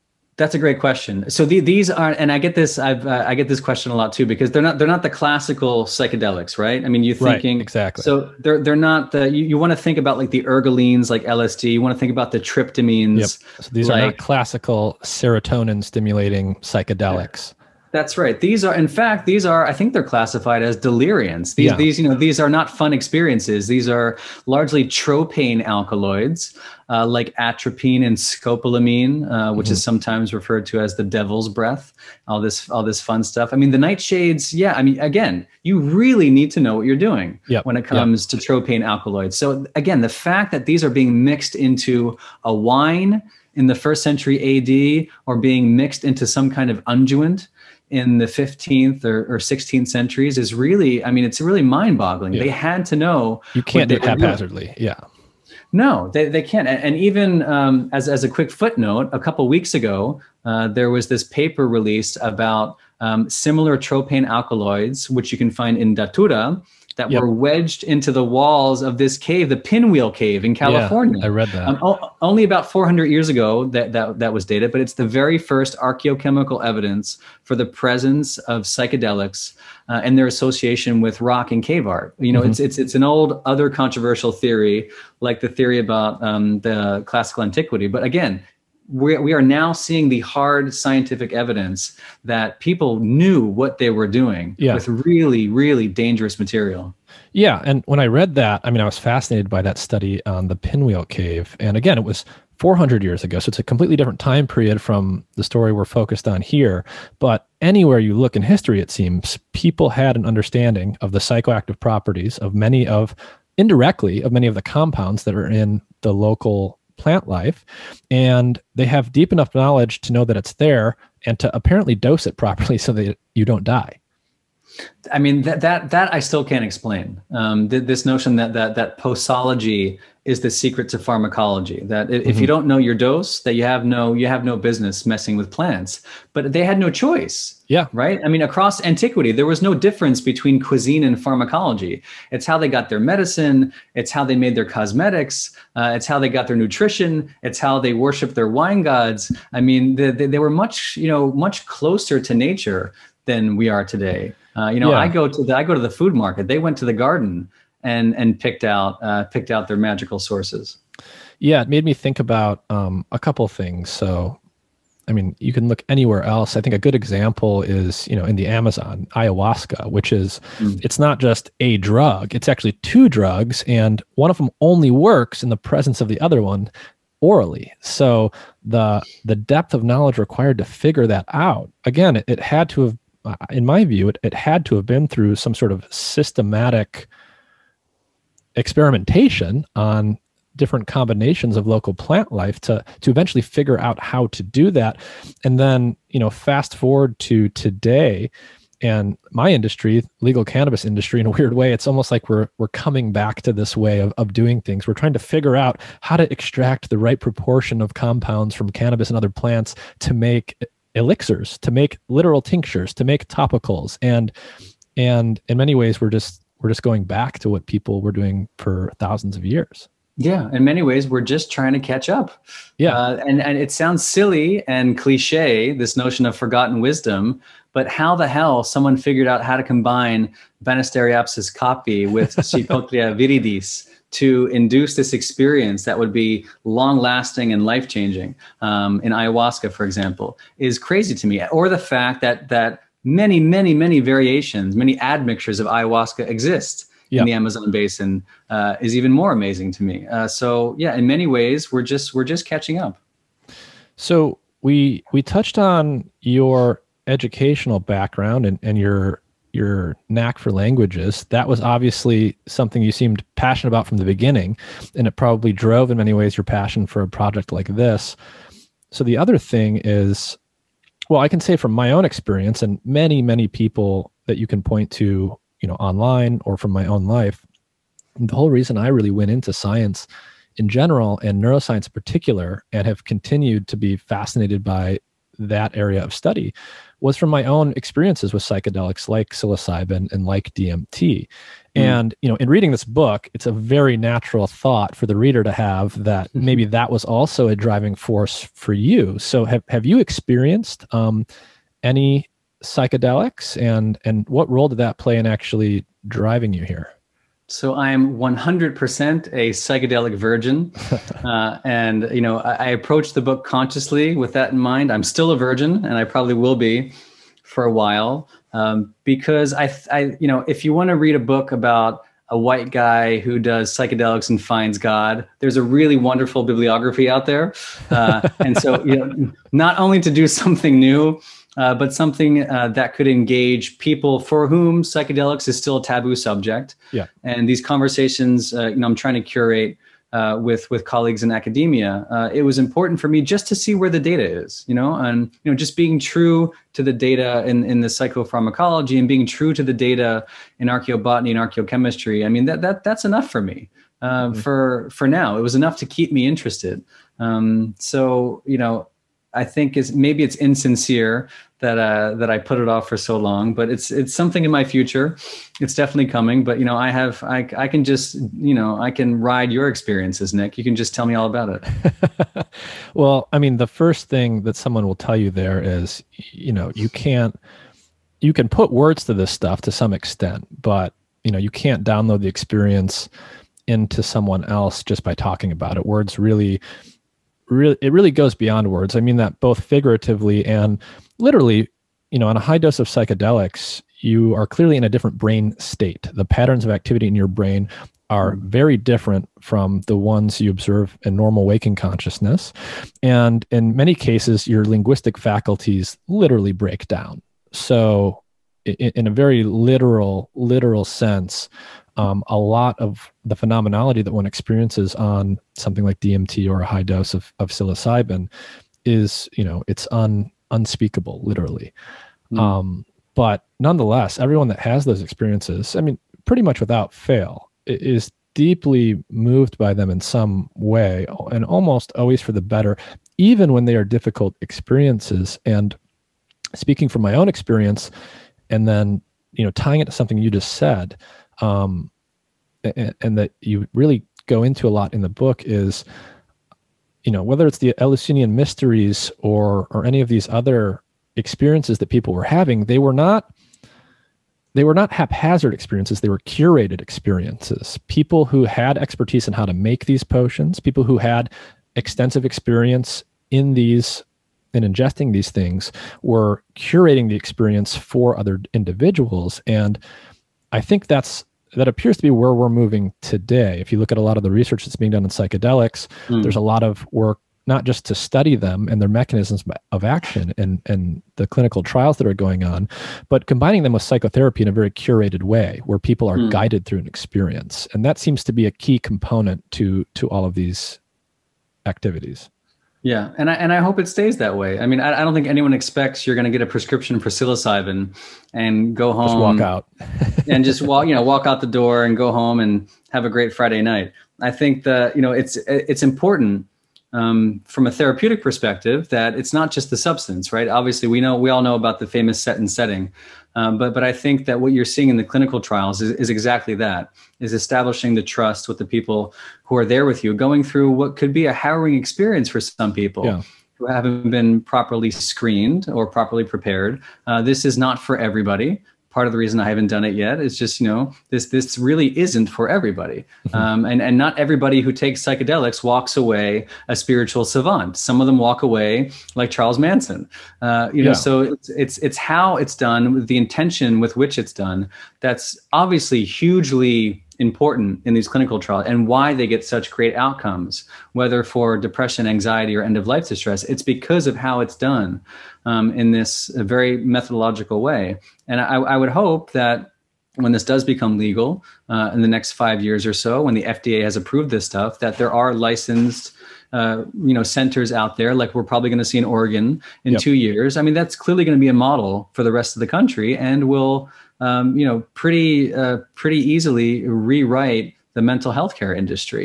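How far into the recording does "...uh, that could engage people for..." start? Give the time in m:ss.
5:32.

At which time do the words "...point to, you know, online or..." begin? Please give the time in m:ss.
4:34.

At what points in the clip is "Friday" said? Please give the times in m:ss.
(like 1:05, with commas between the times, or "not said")
8:23.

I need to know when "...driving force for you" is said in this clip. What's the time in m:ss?
4:57.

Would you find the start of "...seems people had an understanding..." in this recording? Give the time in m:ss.
1:48.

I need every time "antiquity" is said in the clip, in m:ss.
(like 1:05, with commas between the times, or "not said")
1:27, 2:18.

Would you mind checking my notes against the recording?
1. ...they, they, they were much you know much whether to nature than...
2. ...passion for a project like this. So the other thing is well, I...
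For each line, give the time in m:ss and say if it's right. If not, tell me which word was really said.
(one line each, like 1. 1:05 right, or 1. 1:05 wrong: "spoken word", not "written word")
1. 2:29 wrong: "closer", not "whether"
2. 4:26 right.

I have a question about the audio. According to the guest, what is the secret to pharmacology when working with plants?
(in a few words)
posology.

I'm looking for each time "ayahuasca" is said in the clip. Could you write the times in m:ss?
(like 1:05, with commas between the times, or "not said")
2:49, 3:59, 4:05.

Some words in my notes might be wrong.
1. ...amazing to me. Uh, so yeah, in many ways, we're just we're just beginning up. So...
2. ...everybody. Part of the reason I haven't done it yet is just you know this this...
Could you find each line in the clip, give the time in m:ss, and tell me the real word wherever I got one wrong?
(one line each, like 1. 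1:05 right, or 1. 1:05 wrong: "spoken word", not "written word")
1. 4:09 wrong: "catching", not "beginning"
2. 8:47 right.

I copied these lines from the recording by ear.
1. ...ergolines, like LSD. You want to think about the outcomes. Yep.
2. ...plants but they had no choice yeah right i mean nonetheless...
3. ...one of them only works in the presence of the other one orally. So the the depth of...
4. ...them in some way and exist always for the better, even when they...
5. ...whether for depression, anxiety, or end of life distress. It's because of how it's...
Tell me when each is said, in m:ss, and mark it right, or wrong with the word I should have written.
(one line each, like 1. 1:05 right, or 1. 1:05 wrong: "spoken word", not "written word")
1. 0:10 wrong: "tryptamines", not "outcomes"
2. 2:15 wrong: "across", not "nonetheless"
3. 2:54 right
4. 7:09 wrong: "almost", not "exist"
5. 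9:10 right.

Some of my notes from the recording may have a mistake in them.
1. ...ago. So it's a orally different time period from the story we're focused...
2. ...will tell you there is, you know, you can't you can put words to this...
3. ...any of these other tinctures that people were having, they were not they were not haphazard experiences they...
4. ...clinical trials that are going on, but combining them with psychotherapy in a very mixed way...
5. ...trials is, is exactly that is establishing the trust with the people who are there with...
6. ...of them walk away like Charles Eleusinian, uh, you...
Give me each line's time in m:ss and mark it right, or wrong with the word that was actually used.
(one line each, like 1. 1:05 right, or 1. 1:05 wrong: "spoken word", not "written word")
1. 1:43 wrong: "completely", not "orally"
2. 6:14 right
3. 7:29 wrong: "experiences", not "tinctures"
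4. 8:01 wrong: "curated", not "mixed"
5. 8:35 right
6. 8:58 wrong: "Manson", not "Eleusinian".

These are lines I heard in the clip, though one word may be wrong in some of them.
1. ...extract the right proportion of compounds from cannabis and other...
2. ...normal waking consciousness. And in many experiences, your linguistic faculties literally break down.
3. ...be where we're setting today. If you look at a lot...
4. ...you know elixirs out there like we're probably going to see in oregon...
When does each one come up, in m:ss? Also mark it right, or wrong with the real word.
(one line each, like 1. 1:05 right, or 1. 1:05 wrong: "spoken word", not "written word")
1. 3:26 right
2. 6:41 wrong: "cases", not "experiences"
3. 7:52 wrong: "moving", not "setting"
4. 9:27 wrong: "centers", not "elixirs".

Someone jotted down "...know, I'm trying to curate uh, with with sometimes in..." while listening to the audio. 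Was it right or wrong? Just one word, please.
wrong.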